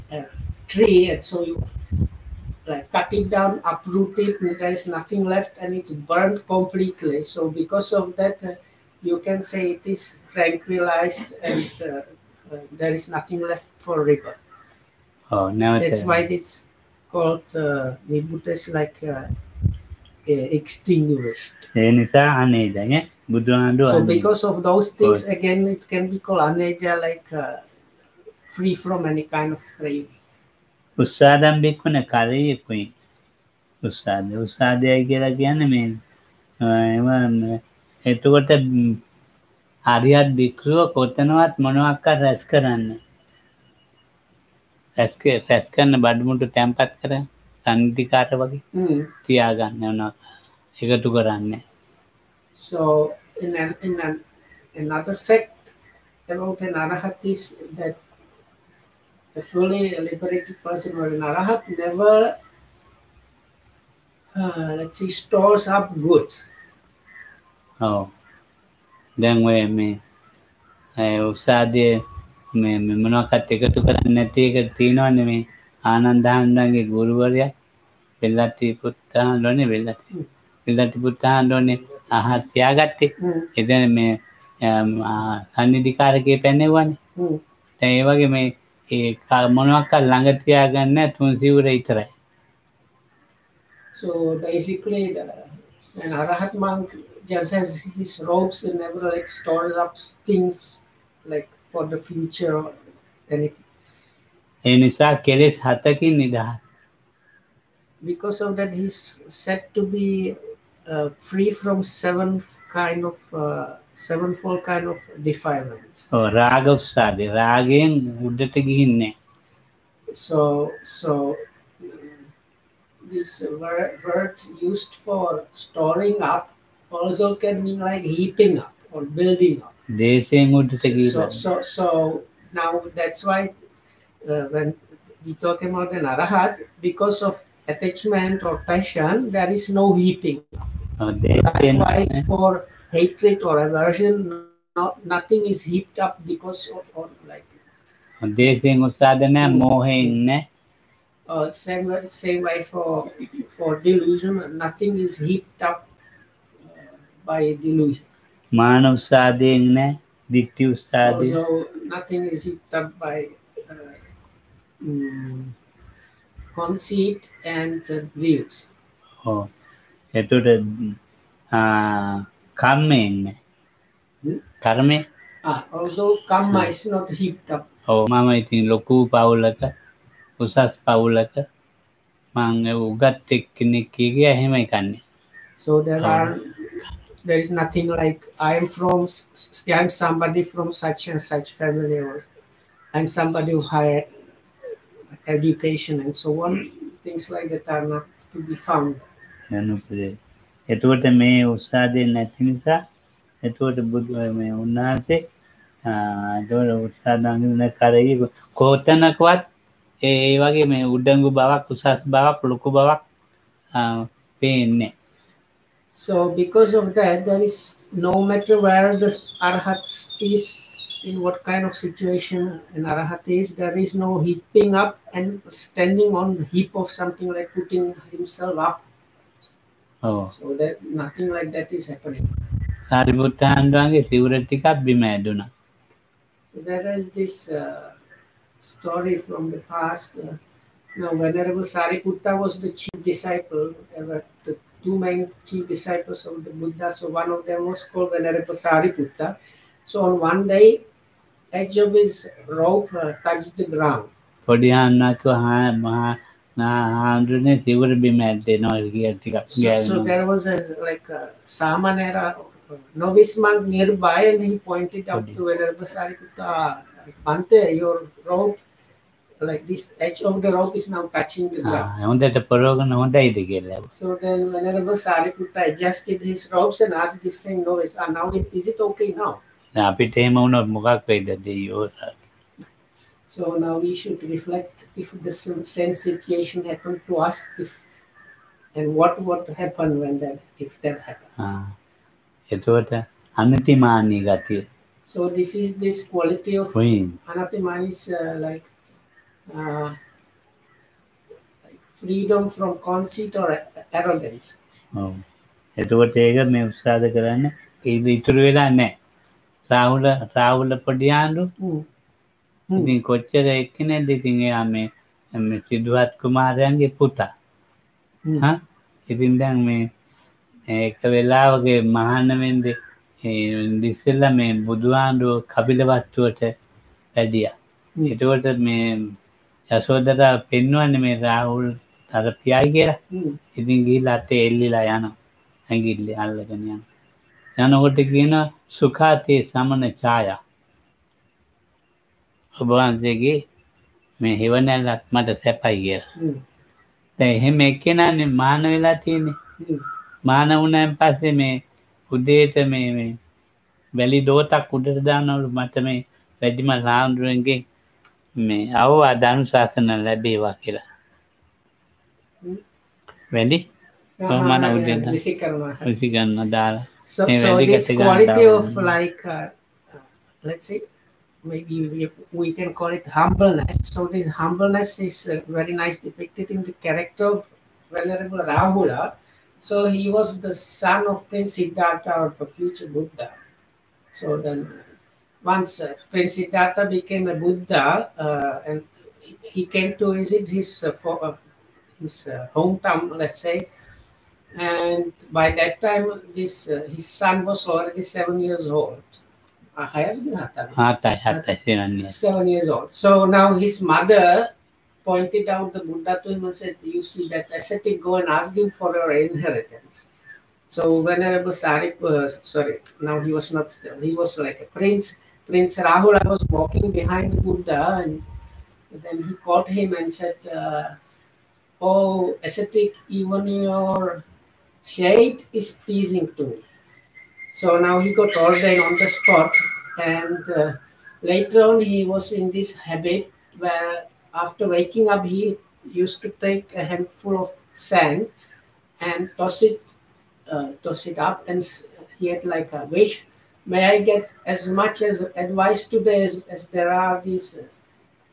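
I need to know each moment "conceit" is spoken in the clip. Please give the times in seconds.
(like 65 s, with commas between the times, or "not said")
166 s, 302 s.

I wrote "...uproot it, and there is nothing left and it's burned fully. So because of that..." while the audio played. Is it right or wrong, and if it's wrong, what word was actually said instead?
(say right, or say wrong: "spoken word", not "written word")
wrong: "completely", not "fully".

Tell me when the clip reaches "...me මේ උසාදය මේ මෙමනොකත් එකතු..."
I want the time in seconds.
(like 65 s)
69 s.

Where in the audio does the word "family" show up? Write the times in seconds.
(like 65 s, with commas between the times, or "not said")
191 s.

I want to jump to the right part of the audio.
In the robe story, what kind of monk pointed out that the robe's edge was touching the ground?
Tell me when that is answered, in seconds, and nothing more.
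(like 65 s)
261 s.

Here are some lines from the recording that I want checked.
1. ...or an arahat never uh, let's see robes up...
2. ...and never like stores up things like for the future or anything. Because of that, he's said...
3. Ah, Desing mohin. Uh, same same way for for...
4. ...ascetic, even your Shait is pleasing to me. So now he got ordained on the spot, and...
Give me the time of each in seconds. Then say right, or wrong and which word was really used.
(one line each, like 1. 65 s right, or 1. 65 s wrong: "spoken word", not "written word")
1. 60 s wrong: "stores", not "robes"
2. 98 s right
3. 148 s right
4. 422 s right.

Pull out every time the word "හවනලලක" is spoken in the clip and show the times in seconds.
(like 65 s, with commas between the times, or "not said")
344 s.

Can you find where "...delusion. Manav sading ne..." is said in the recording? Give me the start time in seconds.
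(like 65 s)
157 s.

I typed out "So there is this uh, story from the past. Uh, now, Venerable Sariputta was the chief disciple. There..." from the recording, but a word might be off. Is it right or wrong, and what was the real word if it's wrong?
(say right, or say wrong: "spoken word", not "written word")
right.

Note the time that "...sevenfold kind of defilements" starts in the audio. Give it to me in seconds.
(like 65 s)
113 s.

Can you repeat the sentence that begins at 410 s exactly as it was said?
So Venerable Sarip, uh, sorry, now he was not still, he was like a prince.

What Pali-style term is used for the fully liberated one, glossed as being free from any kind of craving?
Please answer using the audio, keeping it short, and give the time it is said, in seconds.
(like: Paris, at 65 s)
aneja, at 26 s.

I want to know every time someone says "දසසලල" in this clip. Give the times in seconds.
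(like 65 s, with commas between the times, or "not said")
323 s.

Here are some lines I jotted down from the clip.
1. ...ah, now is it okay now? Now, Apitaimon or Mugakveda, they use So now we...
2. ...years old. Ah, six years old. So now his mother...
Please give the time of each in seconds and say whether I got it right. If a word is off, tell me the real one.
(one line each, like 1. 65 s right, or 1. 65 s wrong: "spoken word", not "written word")
1. 277 s right
2. 398 s wrong: "seven", not "six".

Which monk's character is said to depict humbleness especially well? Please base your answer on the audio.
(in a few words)
Venerable Rahula.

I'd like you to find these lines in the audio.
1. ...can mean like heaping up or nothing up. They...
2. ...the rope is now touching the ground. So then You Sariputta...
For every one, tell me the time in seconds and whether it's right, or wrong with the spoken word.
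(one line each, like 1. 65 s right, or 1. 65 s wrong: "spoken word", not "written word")
1. 127 s wrong: "building", not "nothing"
2. 270 s wrong: "Venerable", not "You".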